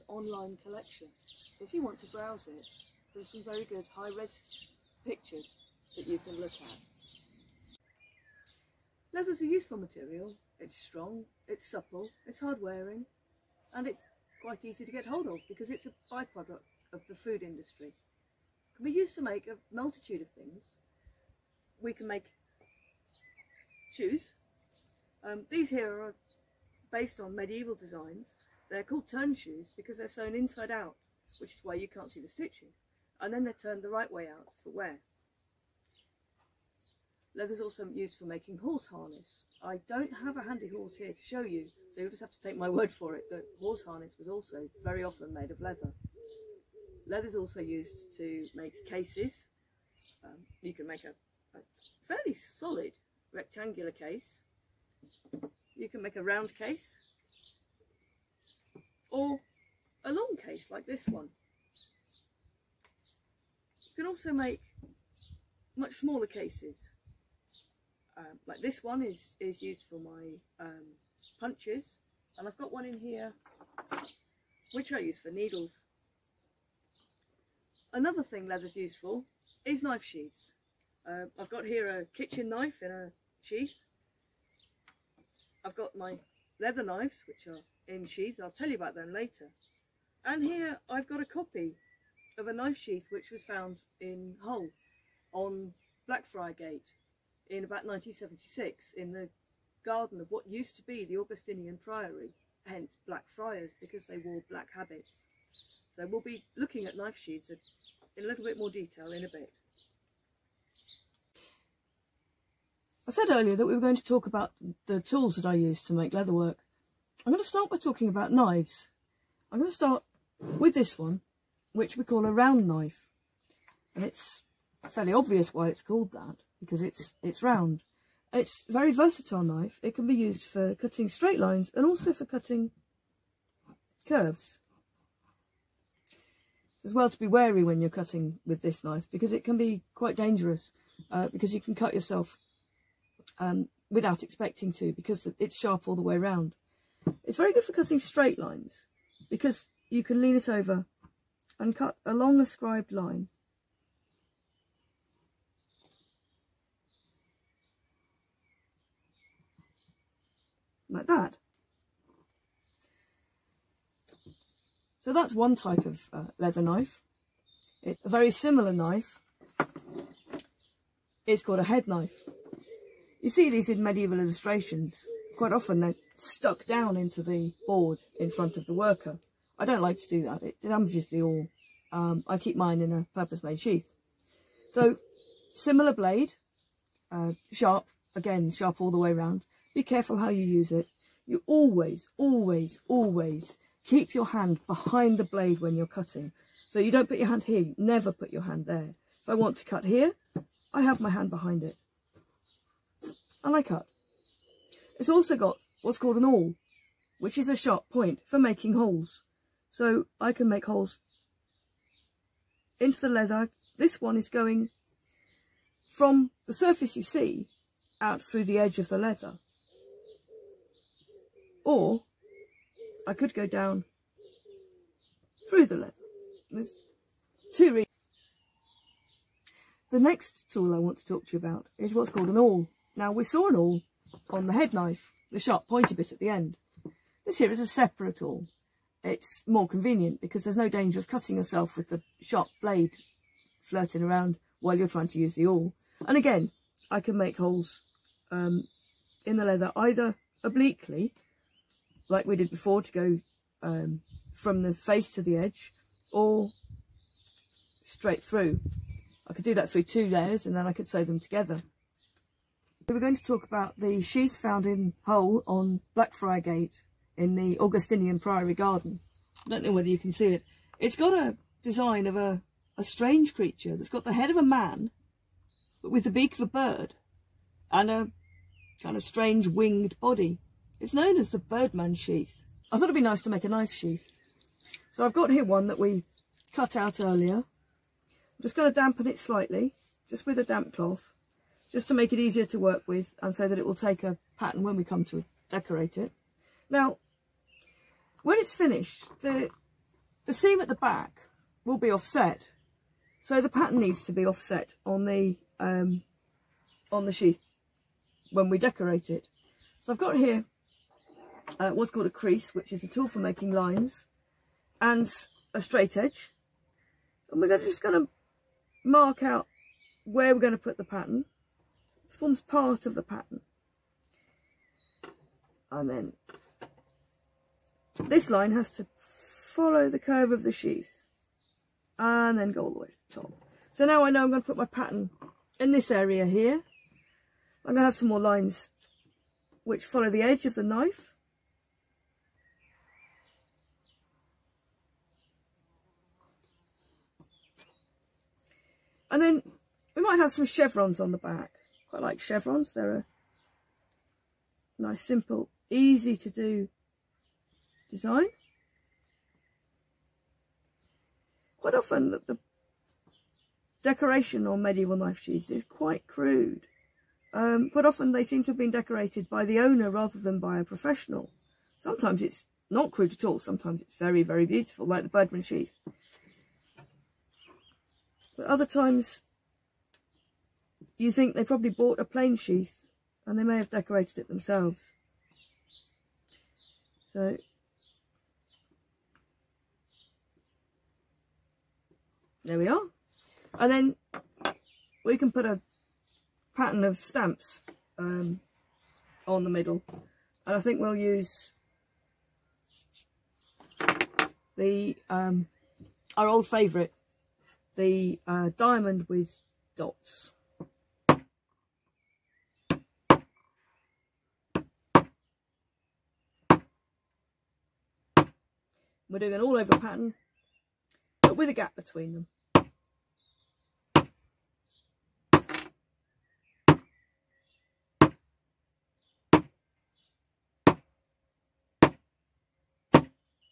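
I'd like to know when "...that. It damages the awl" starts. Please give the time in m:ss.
3:00.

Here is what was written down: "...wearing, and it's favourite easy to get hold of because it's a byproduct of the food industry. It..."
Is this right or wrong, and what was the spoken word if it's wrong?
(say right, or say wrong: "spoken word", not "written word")
wrong: "quite", not "favourite".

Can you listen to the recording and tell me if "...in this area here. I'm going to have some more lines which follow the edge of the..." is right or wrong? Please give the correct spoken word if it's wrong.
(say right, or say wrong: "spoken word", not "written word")
right.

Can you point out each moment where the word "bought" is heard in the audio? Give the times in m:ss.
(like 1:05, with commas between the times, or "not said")
6:21.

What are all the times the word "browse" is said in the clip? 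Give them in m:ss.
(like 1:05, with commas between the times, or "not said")
0:02.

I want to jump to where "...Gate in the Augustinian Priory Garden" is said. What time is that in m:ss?
4:26.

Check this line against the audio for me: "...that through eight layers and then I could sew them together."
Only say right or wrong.
wrong.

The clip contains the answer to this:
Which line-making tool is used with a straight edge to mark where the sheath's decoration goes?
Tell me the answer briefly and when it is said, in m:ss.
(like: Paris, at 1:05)
A crease, at 5:12.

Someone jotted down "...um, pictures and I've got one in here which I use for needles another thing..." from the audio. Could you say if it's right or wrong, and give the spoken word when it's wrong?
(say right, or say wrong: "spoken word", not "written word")
wrong: "punches", not "pictures".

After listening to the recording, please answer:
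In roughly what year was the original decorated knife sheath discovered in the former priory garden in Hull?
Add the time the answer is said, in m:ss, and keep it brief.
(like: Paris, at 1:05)
1976, at 1:37.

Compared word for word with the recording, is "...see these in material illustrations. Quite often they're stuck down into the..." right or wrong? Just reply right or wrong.
wrong.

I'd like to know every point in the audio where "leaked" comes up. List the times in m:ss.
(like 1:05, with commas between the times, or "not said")
not said.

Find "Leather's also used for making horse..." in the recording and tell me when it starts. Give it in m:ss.
0:37.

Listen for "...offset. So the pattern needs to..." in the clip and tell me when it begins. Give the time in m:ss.
5:01.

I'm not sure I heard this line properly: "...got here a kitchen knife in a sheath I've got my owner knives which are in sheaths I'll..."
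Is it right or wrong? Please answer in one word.
wrong.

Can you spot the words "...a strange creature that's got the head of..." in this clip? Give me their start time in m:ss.
4:32.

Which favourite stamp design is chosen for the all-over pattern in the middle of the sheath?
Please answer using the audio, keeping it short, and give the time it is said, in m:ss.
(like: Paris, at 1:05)
Diamond with dots, at 6:48.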